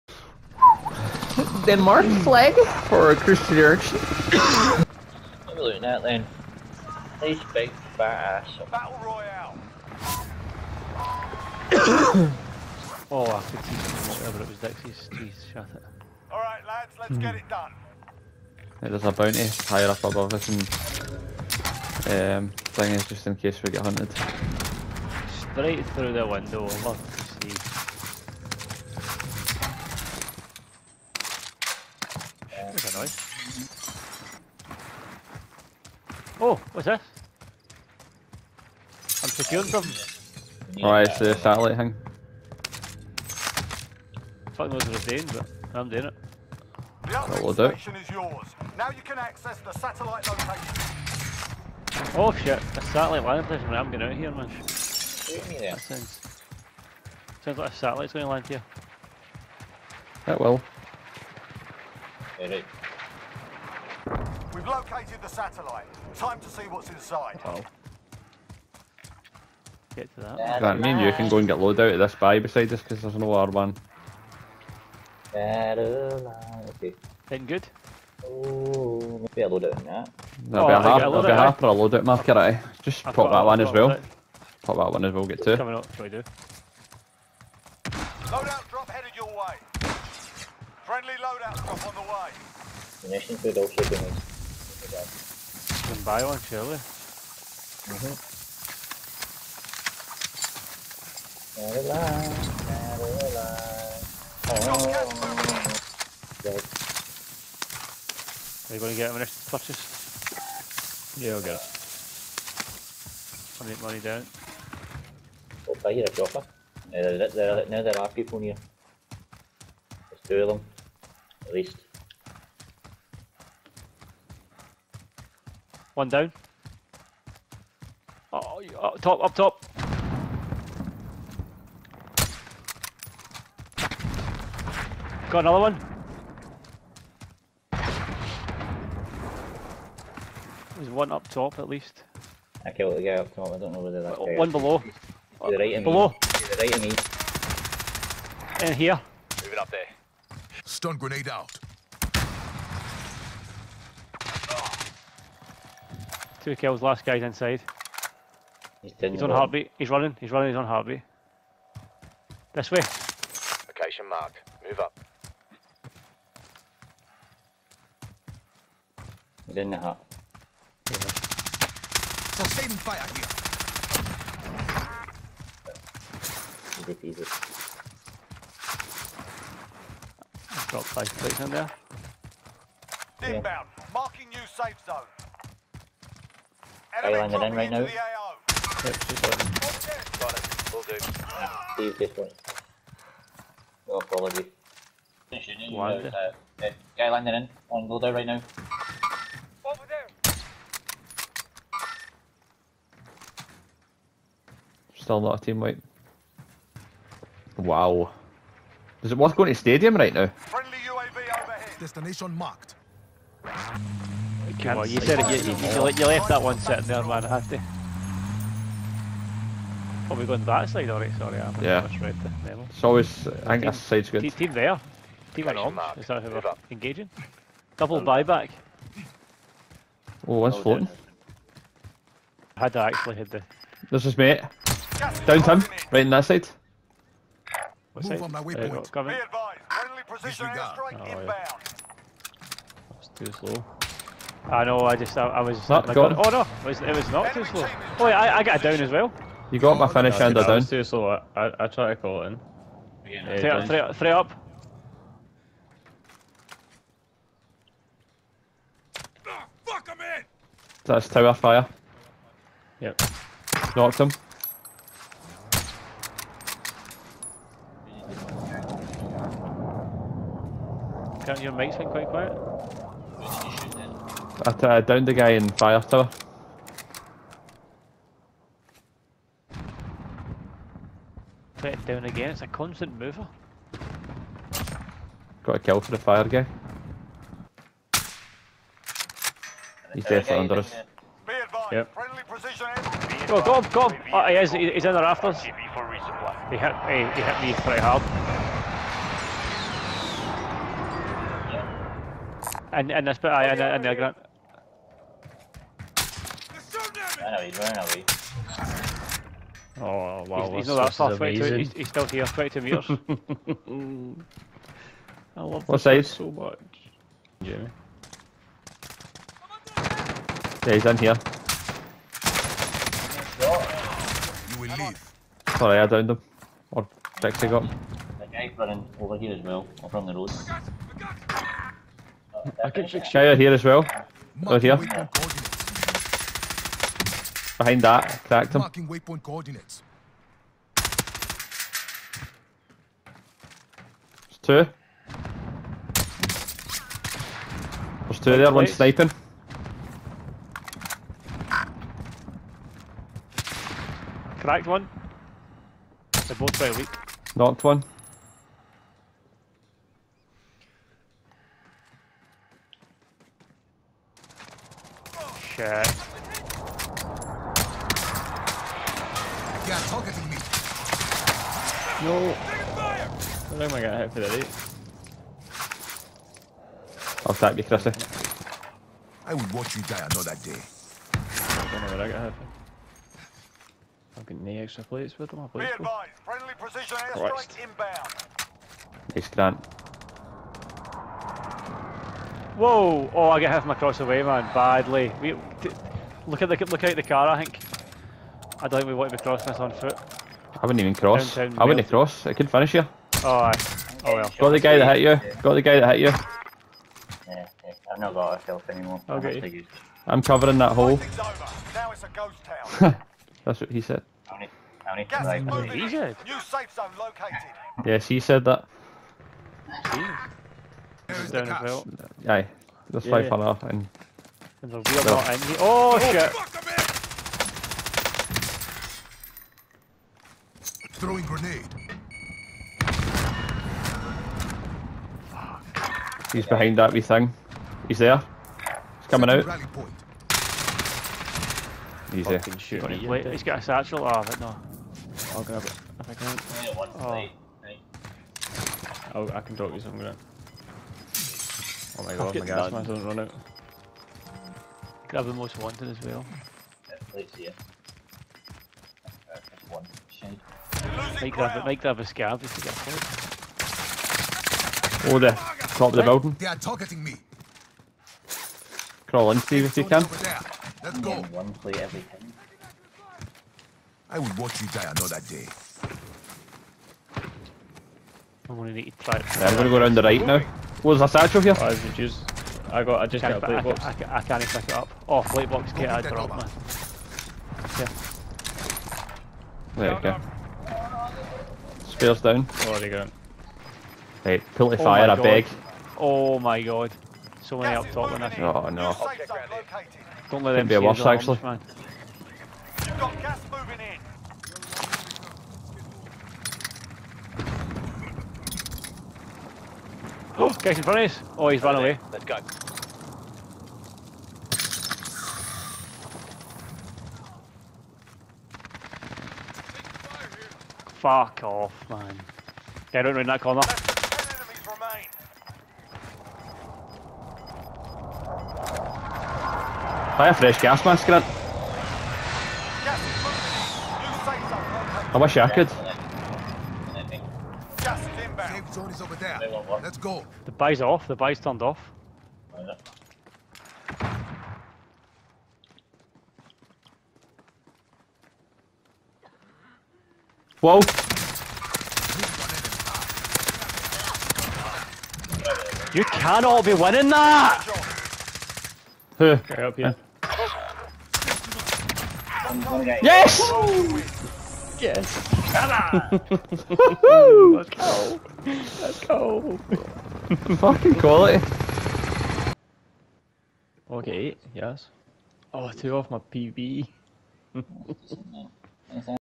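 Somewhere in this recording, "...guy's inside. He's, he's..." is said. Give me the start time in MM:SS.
02:37.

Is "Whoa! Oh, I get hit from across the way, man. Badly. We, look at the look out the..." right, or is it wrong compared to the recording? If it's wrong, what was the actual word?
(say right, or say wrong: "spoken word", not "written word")
right.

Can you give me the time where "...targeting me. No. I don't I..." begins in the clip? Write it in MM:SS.
06:09.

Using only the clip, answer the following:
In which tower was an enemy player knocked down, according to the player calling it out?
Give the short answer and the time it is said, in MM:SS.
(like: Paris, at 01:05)
Fire tower, at 04:35.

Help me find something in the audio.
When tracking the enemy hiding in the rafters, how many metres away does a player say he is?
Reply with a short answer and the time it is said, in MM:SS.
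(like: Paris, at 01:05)
22, at 05:12.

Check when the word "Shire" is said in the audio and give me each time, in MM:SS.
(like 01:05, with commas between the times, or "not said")
05:33.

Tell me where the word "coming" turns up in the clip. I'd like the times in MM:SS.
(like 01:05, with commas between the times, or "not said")
01:25, 07:19.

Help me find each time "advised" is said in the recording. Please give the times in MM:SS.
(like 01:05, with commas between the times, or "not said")
03:59, 06:25.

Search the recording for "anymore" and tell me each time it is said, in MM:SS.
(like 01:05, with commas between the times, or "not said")
06:48.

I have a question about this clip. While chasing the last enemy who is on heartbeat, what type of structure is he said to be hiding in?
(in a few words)
The hut.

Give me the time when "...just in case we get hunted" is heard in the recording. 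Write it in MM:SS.
00:23.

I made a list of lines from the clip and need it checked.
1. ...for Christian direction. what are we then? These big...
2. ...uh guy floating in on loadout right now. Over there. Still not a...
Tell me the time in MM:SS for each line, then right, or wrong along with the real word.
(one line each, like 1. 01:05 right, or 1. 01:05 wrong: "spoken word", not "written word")
1. 00:02 right
2. 03:16 wrong: "landing", not "floating".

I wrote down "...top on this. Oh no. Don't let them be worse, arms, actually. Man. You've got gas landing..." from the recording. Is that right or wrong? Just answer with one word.
wrong.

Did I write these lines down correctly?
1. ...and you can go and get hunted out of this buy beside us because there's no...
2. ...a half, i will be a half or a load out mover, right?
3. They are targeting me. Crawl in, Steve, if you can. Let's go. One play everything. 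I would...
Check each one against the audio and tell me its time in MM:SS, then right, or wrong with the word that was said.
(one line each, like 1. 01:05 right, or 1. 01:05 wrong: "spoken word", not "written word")
1. 01:10 wrong: "loaded", not "hunted"
2. 01:20 wrong: "marker", not "mover"
3. 07:46 right.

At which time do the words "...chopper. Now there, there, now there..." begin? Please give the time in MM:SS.
01:56.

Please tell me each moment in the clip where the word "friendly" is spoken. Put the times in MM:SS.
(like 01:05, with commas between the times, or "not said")
01:30, 03:30, 04:00, 06:26.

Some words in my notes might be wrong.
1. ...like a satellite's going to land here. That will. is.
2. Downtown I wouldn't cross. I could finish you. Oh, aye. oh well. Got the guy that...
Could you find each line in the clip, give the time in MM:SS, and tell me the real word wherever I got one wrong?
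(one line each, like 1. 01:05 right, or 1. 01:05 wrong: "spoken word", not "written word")
1. 00:57 right
2. 06:41 right.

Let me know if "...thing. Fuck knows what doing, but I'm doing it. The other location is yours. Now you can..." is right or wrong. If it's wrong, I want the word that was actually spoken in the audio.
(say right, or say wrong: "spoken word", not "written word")
wrong: "station", not "location".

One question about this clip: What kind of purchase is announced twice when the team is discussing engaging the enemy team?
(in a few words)
Buyback.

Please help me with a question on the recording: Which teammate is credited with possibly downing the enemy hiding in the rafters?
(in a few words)
Dixie.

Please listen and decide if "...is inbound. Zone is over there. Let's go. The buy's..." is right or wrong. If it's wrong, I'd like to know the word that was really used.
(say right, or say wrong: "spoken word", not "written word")
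right.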